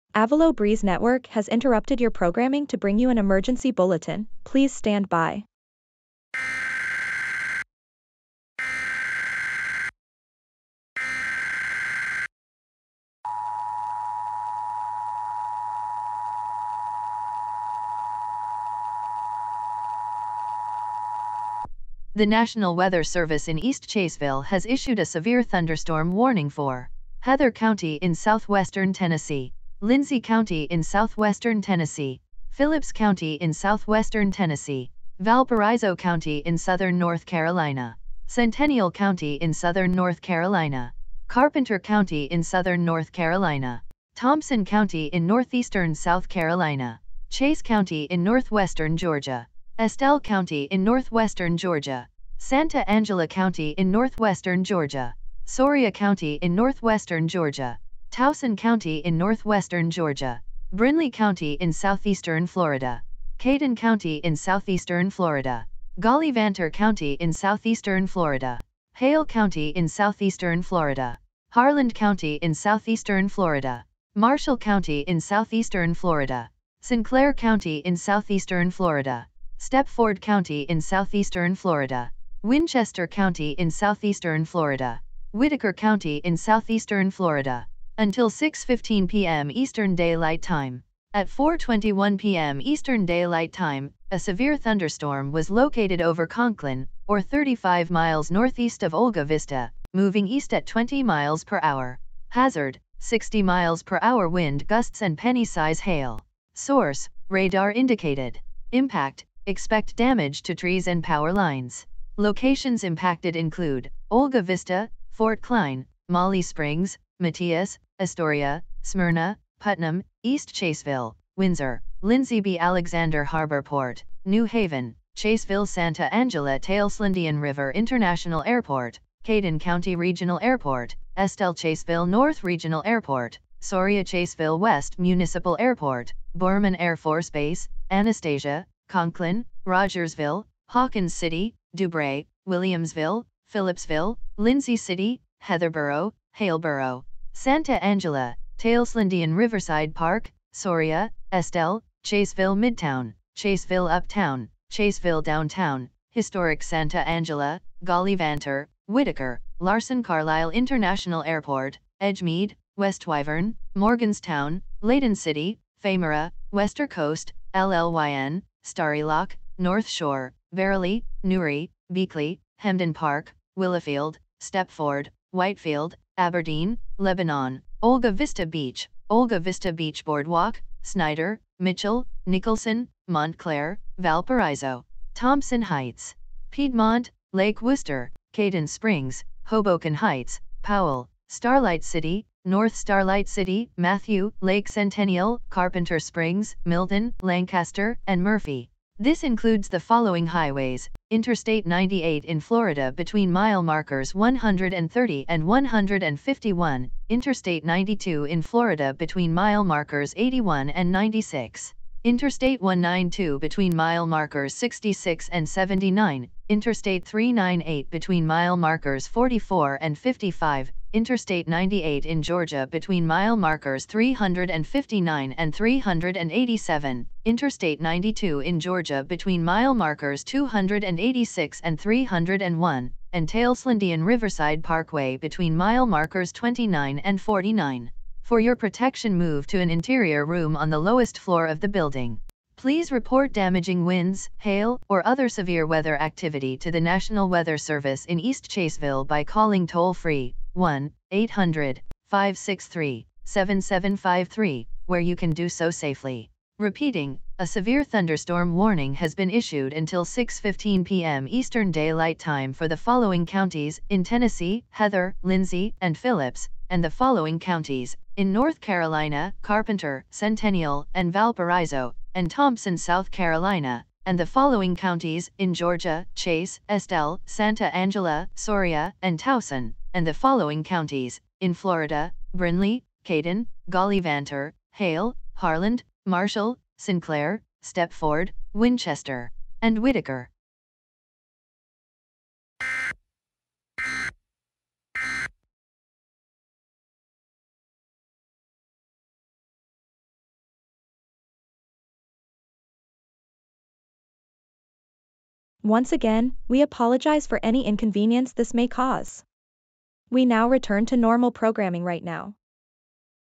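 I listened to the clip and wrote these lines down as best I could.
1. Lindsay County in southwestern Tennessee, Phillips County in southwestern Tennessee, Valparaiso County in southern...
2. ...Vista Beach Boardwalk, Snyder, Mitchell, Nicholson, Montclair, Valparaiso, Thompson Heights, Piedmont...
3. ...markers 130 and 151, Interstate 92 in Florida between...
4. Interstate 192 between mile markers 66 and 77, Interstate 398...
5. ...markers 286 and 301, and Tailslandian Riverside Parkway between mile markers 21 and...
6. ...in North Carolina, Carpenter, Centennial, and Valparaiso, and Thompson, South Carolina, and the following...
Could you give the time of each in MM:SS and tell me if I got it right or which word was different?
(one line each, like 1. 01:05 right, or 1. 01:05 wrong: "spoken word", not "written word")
1. 00:29 right
2. 02:59 right
3. 03:23 right
4. 03:32 wrong: "79", not "77"
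5. 03:49 wrong: "29", not "21"
6. 04:28 right.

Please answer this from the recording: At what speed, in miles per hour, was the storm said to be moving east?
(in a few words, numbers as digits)
20 mph.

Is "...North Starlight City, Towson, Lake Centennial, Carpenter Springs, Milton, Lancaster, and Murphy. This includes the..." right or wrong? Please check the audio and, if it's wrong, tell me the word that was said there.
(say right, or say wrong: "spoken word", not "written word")
wrong: "Matthew", not "Towson".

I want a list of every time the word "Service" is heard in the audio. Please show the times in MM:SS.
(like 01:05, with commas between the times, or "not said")
00:23, 04:07.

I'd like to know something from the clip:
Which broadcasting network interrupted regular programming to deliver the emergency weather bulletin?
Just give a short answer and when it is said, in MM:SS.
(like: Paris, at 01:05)
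Avelo Breeze Network, at 00:00.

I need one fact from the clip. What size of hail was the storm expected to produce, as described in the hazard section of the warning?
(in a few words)
penny-size.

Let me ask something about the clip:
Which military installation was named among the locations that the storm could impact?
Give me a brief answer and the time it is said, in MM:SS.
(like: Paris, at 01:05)
Borman Air Force Base, at 02:16.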